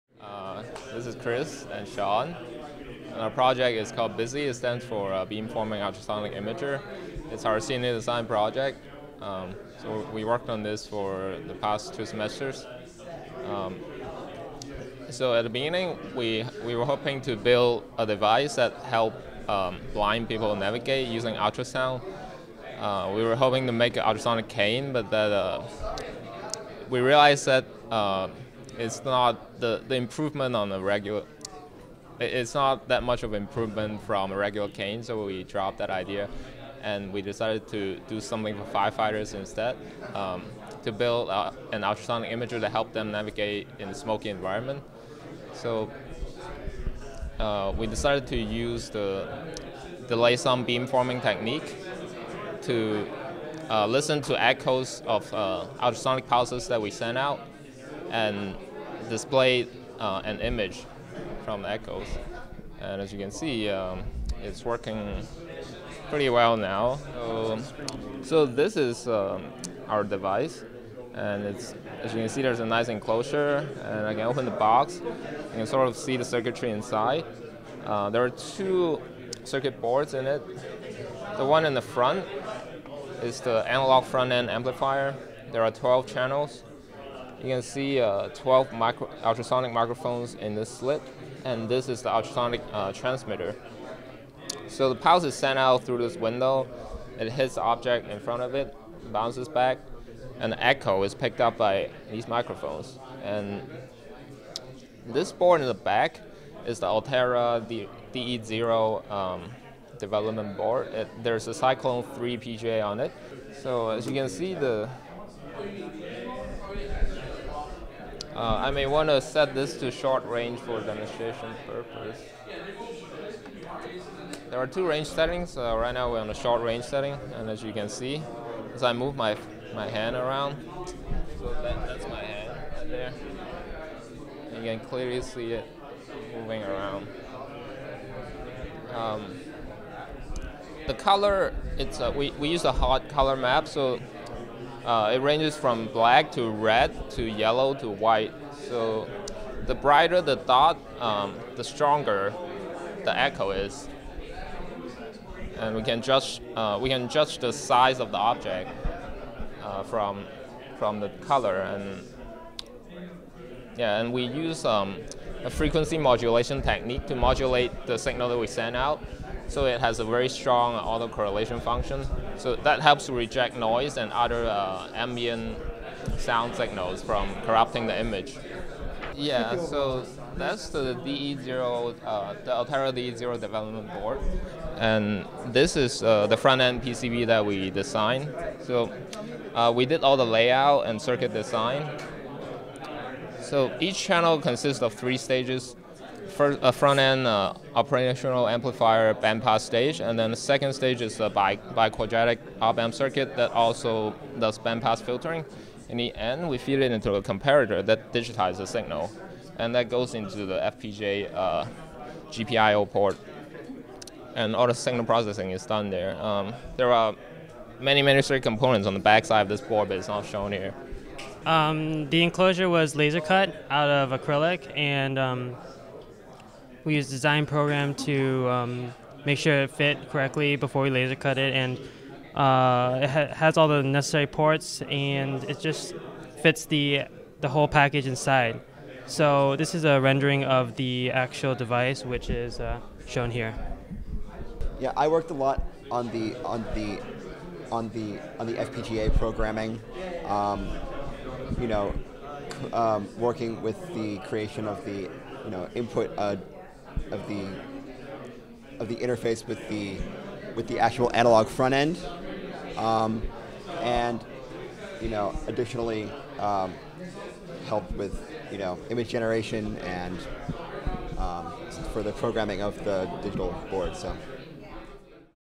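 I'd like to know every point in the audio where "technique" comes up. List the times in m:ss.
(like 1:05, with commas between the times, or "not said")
0:51, 2:46.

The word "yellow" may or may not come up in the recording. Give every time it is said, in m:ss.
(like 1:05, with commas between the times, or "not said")
2:27.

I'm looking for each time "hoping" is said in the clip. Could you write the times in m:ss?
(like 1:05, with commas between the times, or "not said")
0:16, 0:23.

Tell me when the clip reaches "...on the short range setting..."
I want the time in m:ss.
2:06.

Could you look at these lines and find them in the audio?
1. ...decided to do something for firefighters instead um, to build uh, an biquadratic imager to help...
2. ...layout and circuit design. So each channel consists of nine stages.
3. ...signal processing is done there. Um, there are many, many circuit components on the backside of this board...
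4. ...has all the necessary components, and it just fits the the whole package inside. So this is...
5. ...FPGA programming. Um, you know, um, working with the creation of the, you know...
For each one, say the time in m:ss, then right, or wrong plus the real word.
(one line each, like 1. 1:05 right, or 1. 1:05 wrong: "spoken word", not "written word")
1. 0:37 wrong: "ultrasonic", not "biquadratic"
2. 3:10 wrong: "three", not "nine"
3. 3:34 right
4. 3:53 wrong: "ports", not "components"
5. 4:08 right.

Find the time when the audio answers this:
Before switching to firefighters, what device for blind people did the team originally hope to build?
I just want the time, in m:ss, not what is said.
0:24.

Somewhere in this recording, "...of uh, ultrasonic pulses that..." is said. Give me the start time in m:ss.
0:55.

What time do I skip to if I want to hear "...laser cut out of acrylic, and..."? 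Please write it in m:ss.
3:42.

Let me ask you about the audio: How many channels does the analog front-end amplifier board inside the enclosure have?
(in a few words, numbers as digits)
12.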